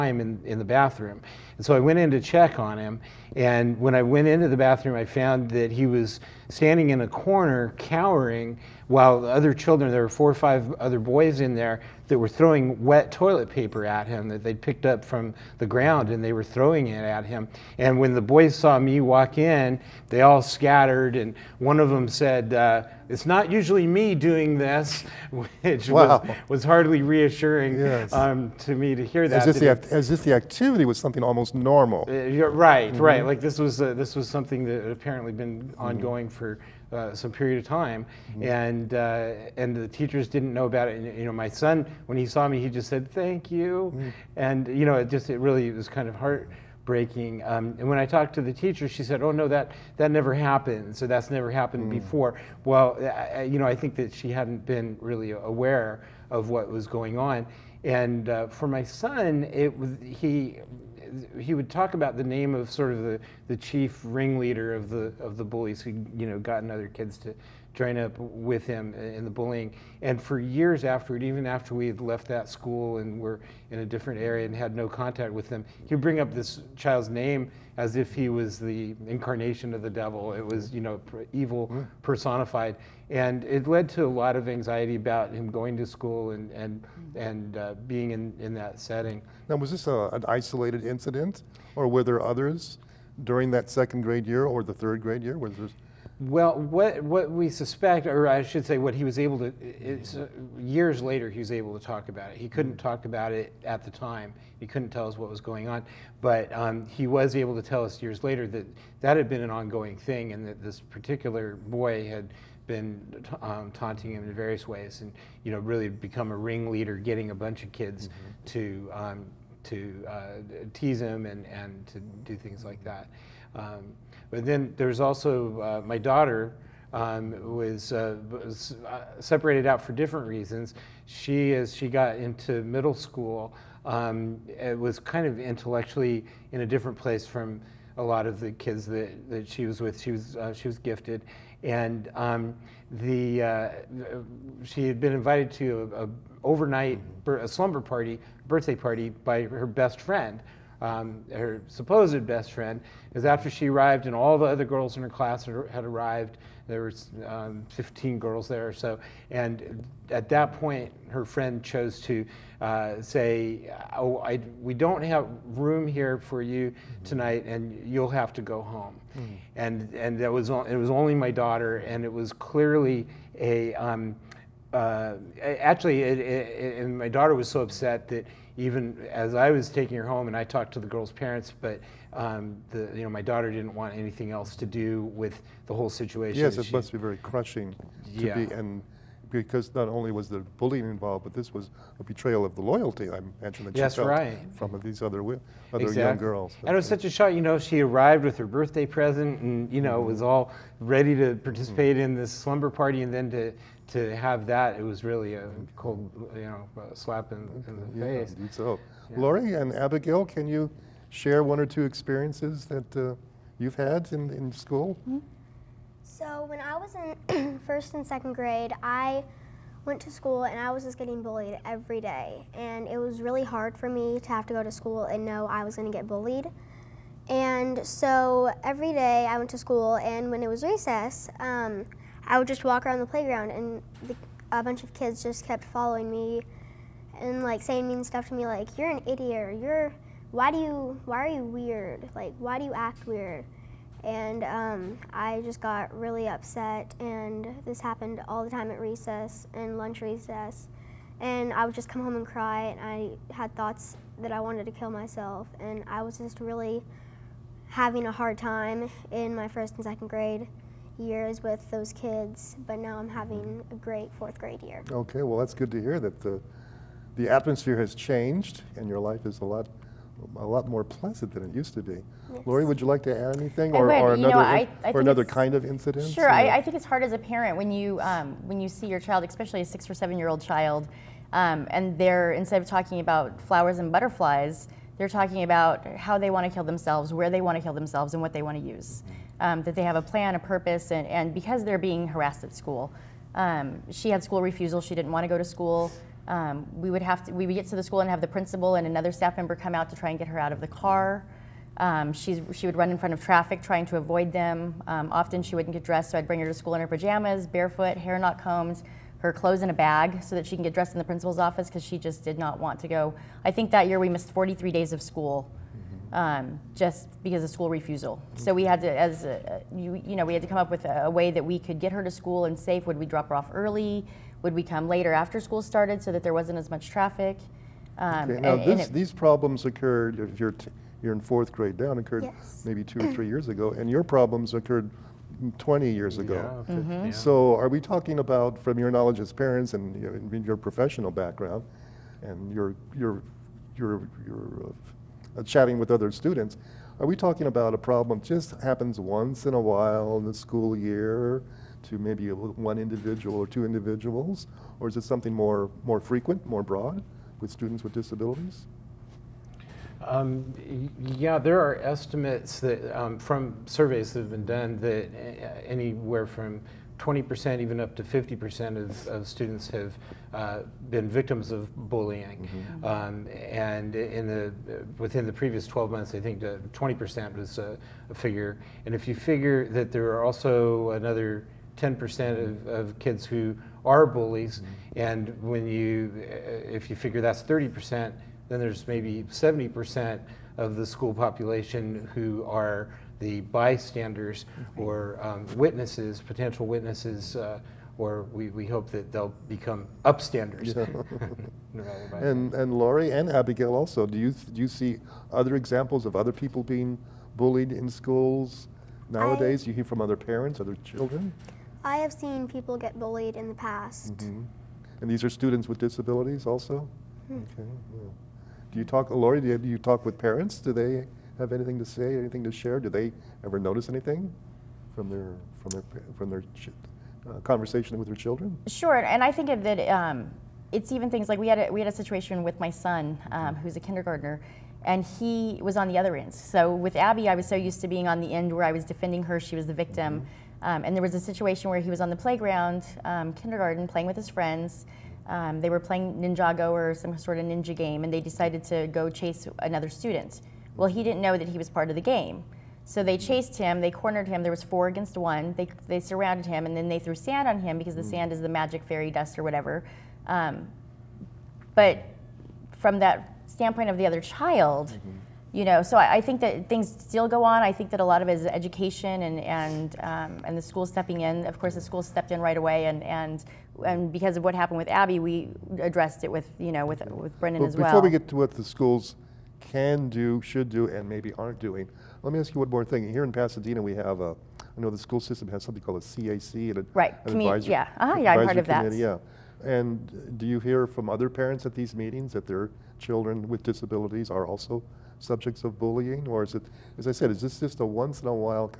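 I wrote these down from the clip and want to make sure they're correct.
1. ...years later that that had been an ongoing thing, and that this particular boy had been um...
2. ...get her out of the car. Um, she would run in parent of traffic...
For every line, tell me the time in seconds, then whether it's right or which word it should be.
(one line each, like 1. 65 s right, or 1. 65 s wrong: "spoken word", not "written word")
1. 108 s right
2. 300 s wrong: "front", not "parent".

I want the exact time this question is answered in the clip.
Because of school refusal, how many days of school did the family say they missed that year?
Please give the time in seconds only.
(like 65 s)
314 s.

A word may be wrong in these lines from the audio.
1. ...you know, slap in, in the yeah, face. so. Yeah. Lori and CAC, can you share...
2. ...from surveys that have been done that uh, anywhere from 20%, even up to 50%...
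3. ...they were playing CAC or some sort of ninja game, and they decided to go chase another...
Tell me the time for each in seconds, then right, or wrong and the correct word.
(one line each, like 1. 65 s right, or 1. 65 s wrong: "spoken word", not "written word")
1. 206 s wrong: "Abigail", not "CAC"
2. 363 s right
3. 445 s wrong: "Ninjago", not "CAC".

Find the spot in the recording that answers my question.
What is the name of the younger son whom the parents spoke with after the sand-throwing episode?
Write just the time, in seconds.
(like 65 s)
477 s.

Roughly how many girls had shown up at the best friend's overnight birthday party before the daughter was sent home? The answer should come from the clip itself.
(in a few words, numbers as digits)
15.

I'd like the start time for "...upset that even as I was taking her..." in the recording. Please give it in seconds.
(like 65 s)
177 s.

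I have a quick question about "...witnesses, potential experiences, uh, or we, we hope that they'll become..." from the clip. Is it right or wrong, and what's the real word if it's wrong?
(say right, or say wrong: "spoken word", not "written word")
wrong: "witnesses", not "experiences".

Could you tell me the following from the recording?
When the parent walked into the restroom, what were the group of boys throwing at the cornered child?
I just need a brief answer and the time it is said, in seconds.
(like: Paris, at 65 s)
Wet toilet paper, at 12 s.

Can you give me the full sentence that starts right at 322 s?
Would we drop her off early?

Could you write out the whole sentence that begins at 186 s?
Yes, it must be very crushing to yeah.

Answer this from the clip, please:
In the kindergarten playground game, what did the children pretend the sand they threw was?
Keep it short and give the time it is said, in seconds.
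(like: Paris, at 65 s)
Magic fairy dust, at 458 s.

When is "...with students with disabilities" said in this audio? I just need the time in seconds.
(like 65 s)
357 s.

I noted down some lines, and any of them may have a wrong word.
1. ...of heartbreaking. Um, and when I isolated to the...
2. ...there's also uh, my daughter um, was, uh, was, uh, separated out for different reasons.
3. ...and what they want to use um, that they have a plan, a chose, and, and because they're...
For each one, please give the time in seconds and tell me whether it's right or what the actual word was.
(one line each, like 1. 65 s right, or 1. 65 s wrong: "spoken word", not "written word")
1. 46 s wrong: "talked", not "isolated"
2. 124 s right
3. 288 s wrong: "purpose", not "chose".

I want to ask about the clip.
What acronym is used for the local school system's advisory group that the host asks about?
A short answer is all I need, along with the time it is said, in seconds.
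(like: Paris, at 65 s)
CAC, at 486 s.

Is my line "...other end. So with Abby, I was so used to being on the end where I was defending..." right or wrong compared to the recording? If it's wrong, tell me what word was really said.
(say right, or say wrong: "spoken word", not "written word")
right.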